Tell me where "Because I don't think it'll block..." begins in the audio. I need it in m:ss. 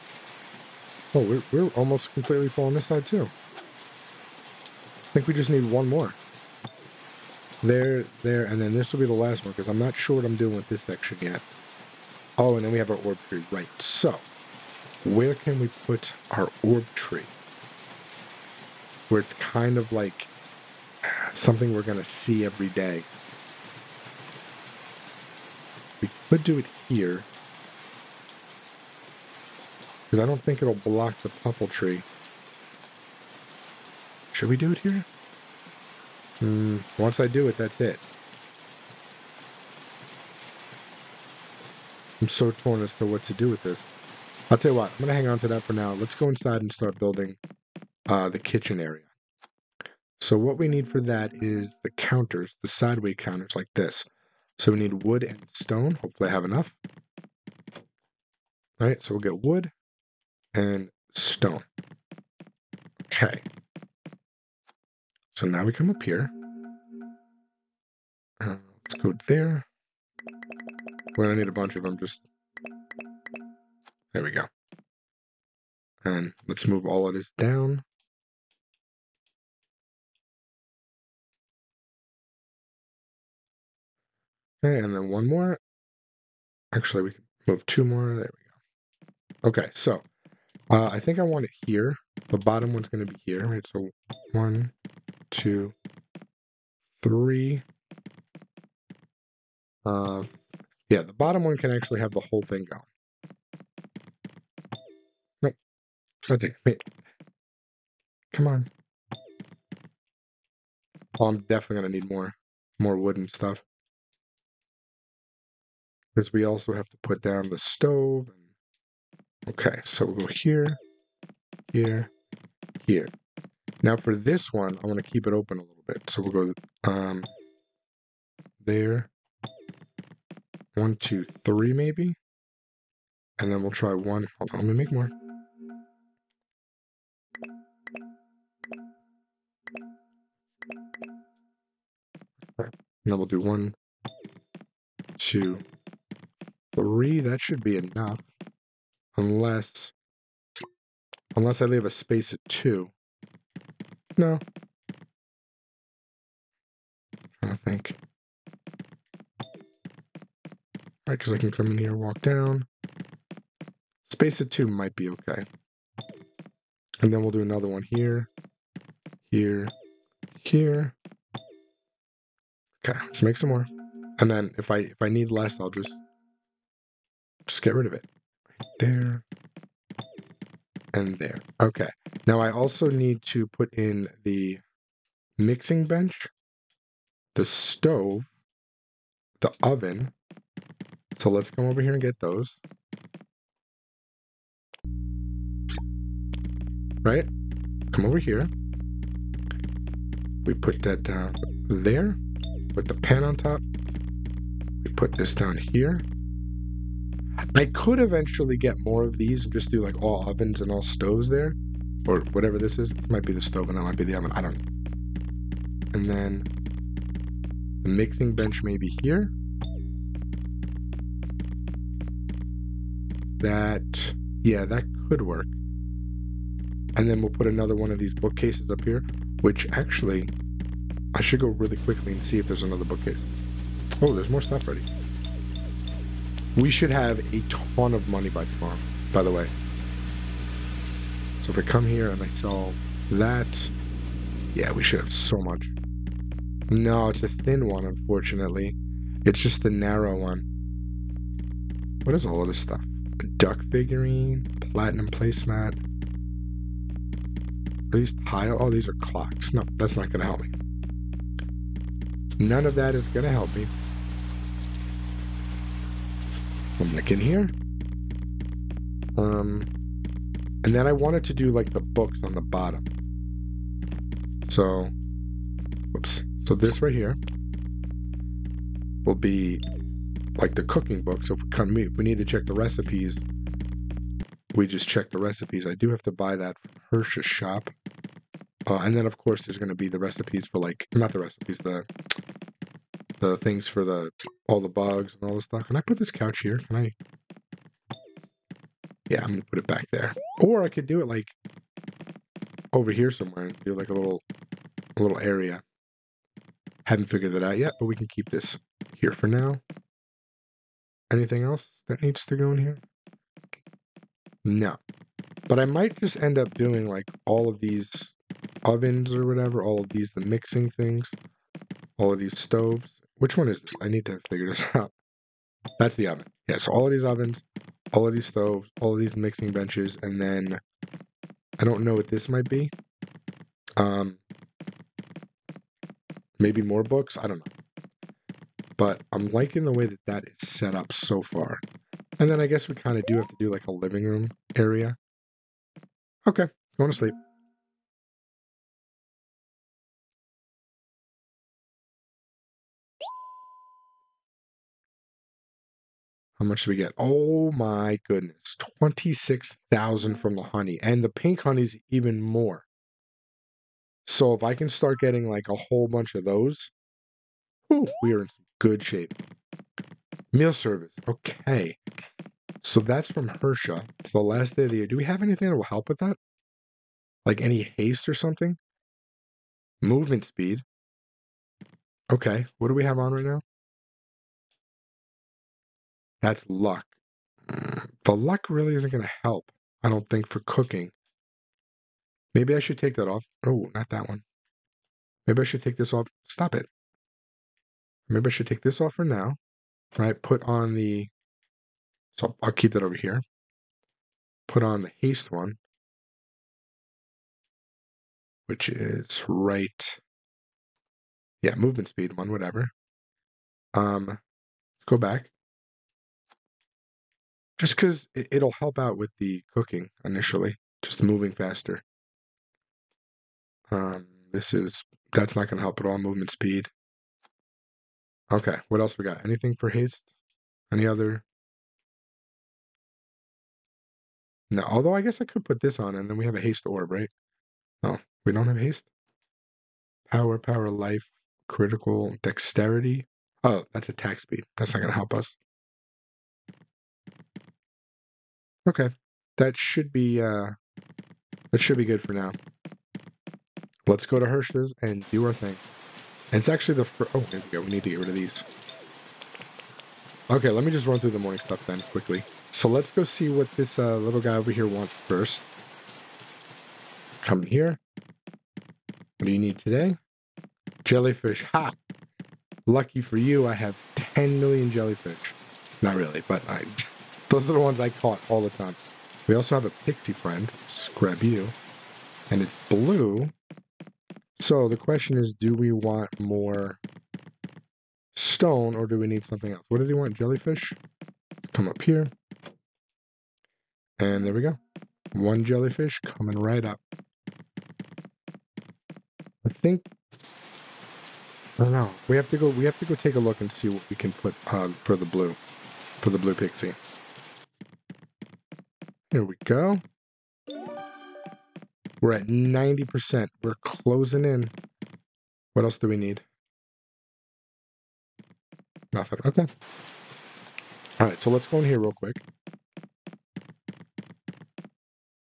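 0:30.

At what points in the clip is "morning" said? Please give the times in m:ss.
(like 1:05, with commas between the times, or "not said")
7:41.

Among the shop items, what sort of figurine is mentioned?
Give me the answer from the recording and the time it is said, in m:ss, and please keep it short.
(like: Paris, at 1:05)
Duck, at 4:13.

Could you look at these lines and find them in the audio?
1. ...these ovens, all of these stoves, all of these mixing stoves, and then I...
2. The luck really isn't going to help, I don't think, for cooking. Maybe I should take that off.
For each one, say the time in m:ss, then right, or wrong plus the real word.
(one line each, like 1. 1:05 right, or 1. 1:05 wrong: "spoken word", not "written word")
1. 5:26 wrong: "benches", not "stoves"
2. 6:28 right.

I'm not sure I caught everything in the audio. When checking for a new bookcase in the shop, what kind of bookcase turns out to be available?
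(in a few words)
The narrow one.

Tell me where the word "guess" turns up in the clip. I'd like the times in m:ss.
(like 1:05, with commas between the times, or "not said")
5:42, 7:15.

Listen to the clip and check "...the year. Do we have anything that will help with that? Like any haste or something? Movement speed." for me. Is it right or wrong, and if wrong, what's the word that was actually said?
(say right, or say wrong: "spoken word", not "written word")
right.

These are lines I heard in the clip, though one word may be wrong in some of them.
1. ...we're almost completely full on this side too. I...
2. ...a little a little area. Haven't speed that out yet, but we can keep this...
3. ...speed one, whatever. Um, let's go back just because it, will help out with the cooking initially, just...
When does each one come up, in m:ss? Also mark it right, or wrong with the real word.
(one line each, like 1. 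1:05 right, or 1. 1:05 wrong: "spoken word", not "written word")
1. 0:01 right
2. 5:03 wrong: "figured", not "speed"
3. 6:51 right.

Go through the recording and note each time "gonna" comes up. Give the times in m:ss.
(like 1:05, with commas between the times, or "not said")
4:59, 7:05.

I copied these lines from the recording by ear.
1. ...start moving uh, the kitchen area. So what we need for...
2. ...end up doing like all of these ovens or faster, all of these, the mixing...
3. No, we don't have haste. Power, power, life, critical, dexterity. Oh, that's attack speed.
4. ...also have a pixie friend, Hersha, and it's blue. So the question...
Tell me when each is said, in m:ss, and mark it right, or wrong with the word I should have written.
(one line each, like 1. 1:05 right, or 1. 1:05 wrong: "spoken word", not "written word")
1. 0:46 wrong: "building", not "moving"
2. 5:16 wrong: "whatever", not "faster"
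3. 7:17 right
4. 7:59 wrong: "Scrabu", not "Hersha".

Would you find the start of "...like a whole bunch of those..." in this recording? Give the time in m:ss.
6:05.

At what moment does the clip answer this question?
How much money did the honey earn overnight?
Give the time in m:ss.
5:58.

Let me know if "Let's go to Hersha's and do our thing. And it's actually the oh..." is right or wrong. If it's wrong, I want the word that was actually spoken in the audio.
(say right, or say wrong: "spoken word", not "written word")
right.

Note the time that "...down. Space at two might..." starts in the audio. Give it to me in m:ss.
2:42.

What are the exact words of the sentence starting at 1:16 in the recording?
And um, let's move all of this down.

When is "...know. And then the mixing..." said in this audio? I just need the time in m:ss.
3:34.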